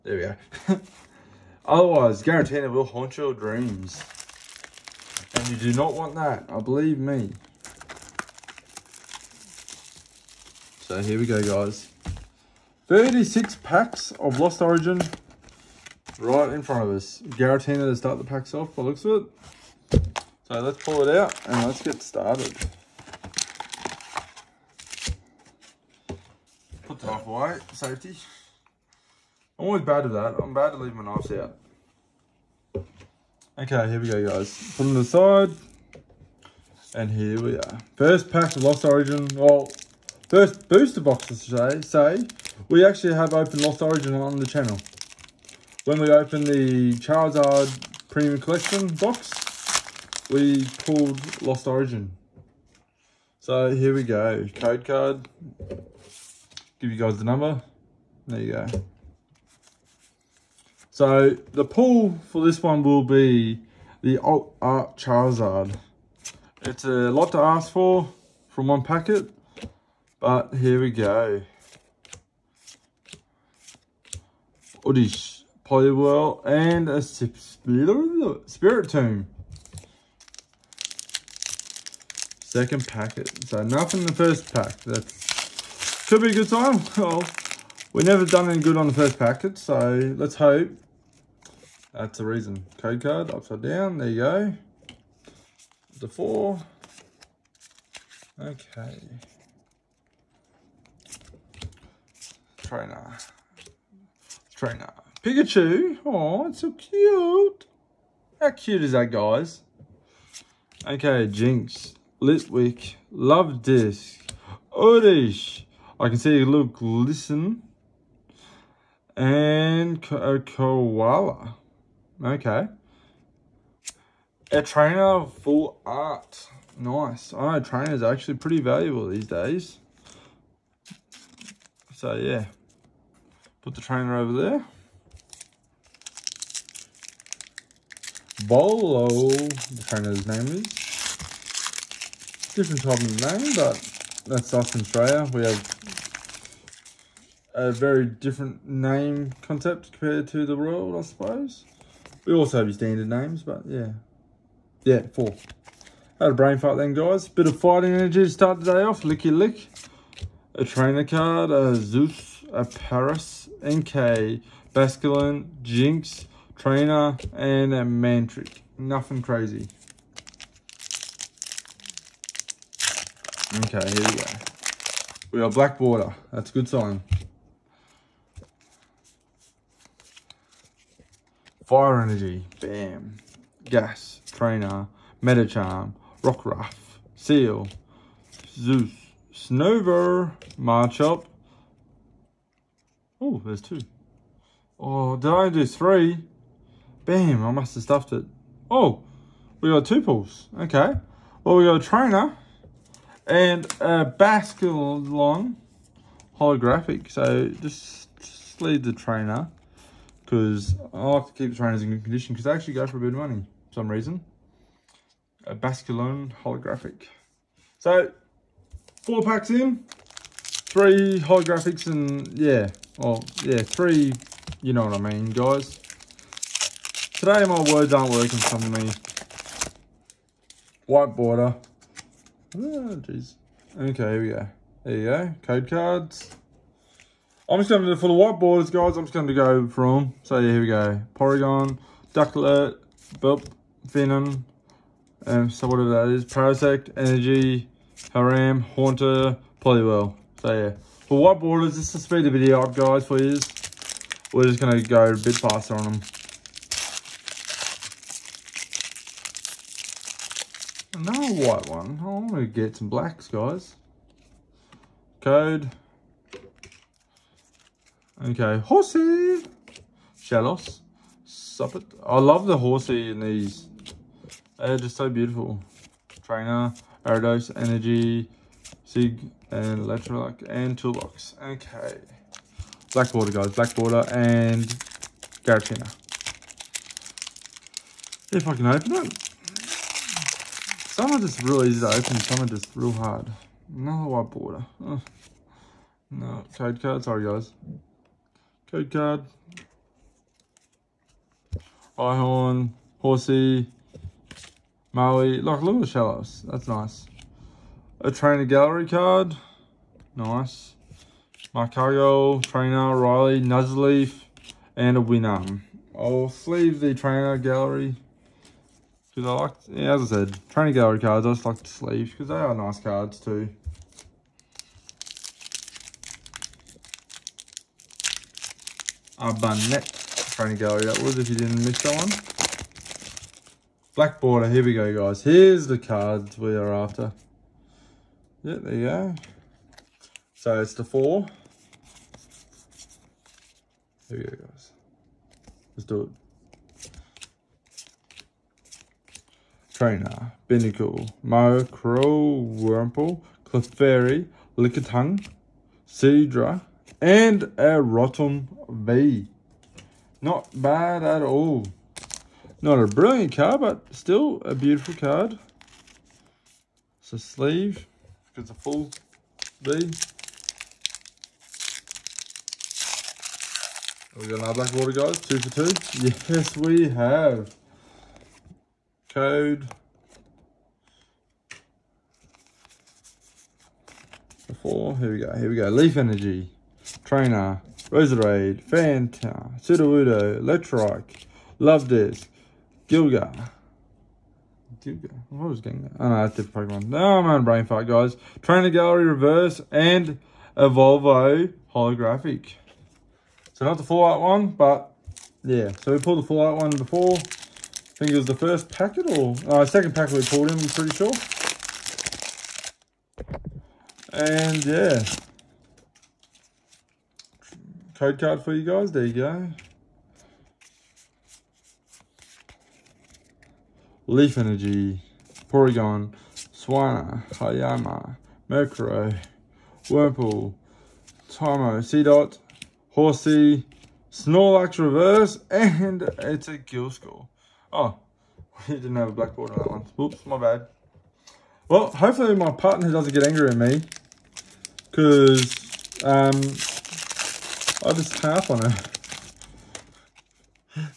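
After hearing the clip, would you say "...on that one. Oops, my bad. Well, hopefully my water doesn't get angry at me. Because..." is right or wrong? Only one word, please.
wrong.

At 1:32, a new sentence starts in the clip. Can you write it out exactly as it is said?
Code card, upside down, there you go.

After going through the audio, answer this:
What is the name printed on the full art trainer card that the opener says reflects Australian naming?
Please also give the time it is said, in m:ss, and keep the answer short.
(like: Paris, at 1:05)
Bolo, at 2:18.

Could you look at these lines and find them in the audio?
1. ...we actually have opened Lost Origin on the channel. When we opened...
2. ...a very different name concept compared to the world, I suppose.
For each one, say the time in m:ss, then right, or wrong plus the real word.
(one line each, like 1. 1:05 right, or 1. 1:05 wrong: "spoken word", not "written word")
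1. 0:42 right
2. 2:27 right.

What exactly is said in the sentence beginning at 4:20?
Another white one we get some blacks, guys.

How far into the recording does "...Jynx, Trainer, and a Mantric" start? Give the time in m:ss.
2:45.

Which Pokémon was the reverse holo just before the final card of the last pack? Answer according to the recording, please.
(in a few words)
Snorlax.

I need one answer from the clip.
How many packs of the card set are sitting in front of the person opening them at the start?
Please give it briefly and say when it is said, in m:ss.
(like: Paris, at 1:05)
36, at 0:12.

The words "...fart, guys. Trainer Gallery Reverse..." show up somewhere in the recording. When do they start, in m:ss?
6:37.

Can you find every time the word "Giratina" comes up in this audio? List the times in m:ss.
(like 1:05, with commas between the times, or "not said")
0:17, 4:45.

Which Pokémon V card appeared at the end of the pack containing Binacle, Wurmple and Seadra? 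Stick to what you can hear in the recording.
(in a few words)
Rotom V.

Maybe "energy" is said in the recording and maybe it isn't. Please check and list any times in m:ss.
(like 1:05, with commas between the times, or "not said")
2:37, 3:02, 4:06, 4:37, 6:25, 7:04.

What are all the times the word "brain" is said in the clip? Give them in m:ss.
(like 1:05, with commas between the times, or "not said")
2:36, 6:37.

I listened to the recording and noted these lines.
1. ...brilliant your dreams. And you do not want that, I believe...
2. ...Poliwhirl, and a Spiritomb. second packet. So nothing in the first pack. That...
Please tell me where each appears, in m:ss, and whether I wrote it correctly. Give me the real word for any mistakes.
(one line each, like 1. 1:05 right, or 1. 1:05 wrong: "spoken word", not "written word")
1. 0:02 wrong: "haunt", not "brilliant"
2. 1:15 right.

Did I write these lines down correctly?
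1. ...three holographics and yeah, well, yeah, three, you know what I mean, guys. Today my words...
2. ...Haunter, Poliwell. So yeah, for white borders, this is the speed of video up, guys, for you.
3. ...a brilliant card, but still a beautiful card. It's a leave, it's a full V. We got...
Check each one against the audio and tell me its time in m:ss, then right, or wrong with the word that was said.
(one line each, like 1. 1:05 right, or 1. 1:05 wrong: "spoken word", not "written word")
1. 3:40 right
2. 4:08 right
3. 6:02 wrong: "sleeve", not "leave".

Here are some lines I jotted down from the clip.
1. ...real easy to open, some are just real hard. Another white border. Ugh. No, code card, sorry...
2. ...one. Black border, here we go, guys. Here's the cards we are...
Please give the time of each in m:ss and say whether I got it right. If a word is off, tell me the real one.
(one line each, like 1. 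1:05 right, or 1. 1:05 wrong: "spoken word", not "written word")
1. 4:51 right
2. 5:31 right.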